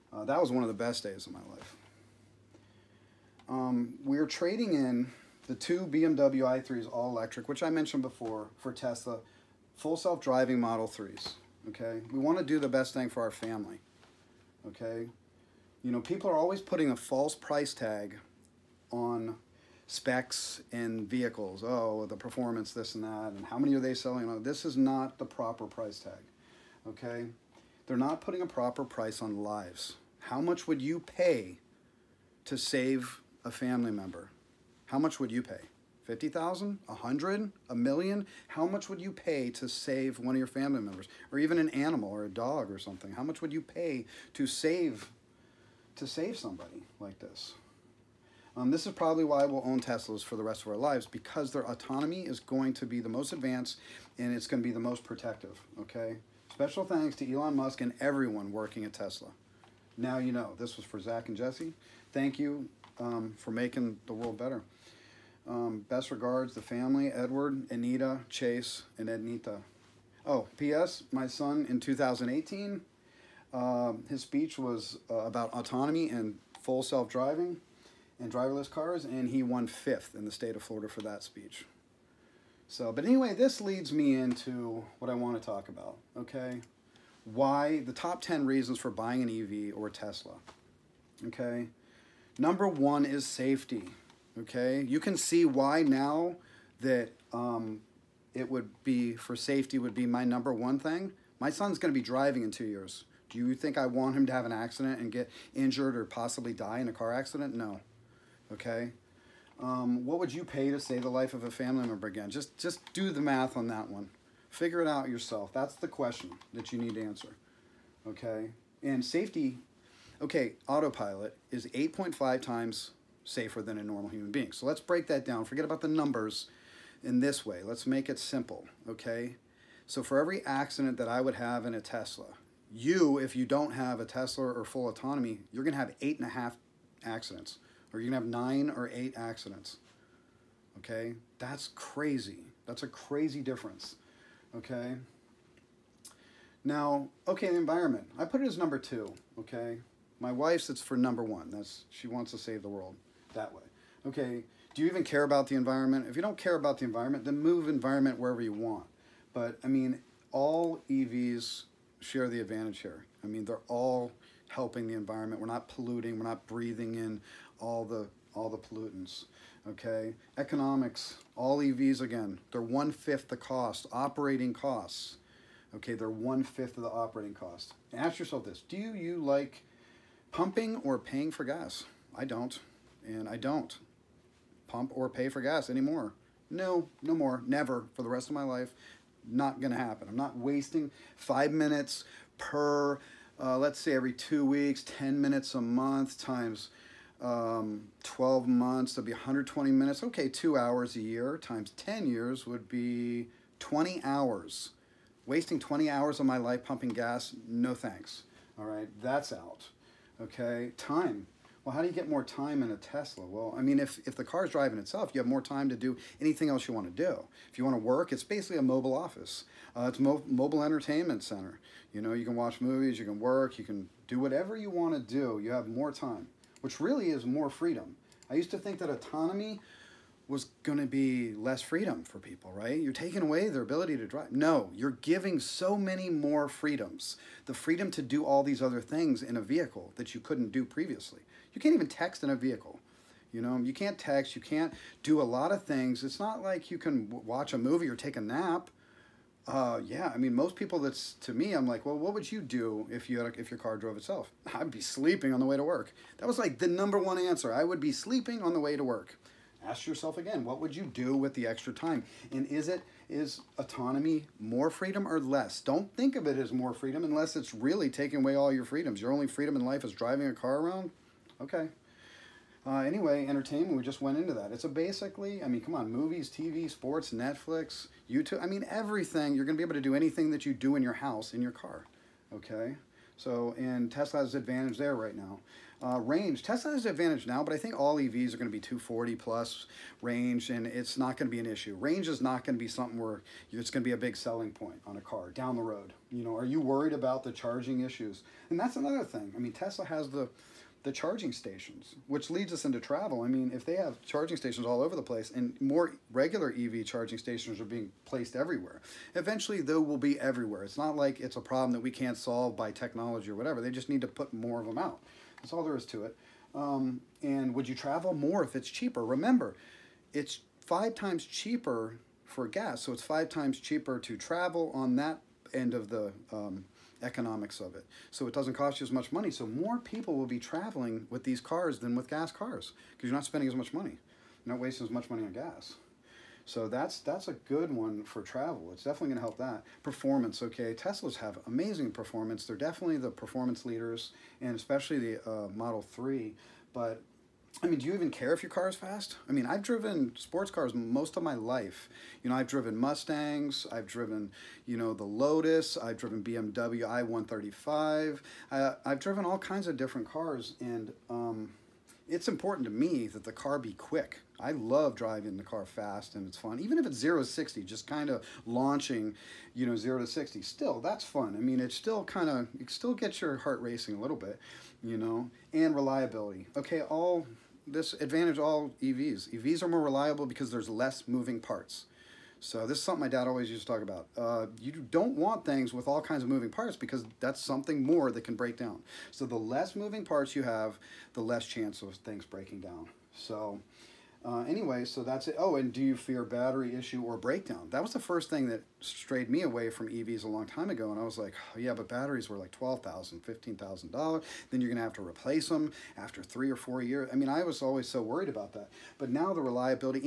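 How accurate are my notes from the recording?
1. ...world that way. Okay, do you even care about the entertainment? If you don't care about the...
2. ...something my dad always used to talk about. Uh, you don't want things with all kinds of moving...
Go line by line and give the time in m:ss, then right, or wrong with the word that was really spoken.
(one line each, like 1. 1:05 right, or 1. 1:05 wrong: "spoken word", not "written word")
1. 2:32 wrong: "environment", not "entertainment"
2. 6:22 right.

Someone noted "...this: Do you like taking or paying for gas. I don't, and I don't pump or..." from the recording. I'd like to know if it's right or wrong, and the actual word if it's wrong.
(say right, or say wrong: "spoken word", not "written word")
wrong: "pumping", not "taking".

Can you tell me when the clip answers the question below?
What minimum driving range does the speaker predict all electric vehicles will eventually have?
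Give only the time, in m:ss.
4:48.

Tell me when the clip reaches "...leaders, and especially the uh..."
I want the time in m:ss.
5:43.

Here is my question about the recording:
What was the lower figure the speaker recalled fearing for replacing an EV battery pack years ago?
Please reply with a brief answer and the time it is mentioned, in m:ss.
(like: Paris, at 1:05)
$12,000, at 6:42.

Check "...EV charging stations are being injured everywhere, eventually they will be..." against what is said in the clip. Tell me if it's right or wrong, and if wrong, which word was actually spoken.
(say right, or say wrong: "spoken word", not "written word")
wrong: "placed", not "injured".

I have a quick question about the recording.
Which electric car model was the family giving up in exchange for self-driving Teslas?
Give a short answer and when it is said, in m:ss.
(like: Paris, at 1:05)
BMW i3, at 0:05.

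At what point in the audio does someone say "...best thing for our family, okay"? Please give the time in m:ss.
0:12.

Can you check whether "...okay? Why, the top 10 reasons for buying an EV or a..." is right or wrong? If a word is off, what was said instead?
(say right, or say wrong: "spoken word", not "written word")
right.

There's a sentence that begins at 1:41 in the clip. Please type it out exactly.
My son's going to be driving in two years.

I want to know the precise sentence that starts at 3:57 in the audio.
The freedom to do all these other things in a vehicle that you couldn't do previously.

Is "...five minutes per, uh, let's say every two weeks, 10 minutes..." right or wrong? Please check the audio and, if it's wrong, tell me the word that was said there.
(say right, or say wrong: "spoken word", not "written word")
right.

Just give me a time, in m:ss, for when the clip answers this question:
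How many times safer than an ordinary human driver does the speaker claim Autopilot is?
2:01.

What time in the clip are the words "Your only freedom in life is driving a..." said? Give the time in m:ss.
4:29.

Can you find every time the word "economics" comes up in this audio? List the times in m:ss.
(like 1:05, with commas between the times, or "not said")
2:50, 5:27.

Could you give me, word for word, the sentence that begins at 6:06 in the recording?
Even if it's 0 to 60, just kind of launching, you know, 0 to 60, still, that's fun.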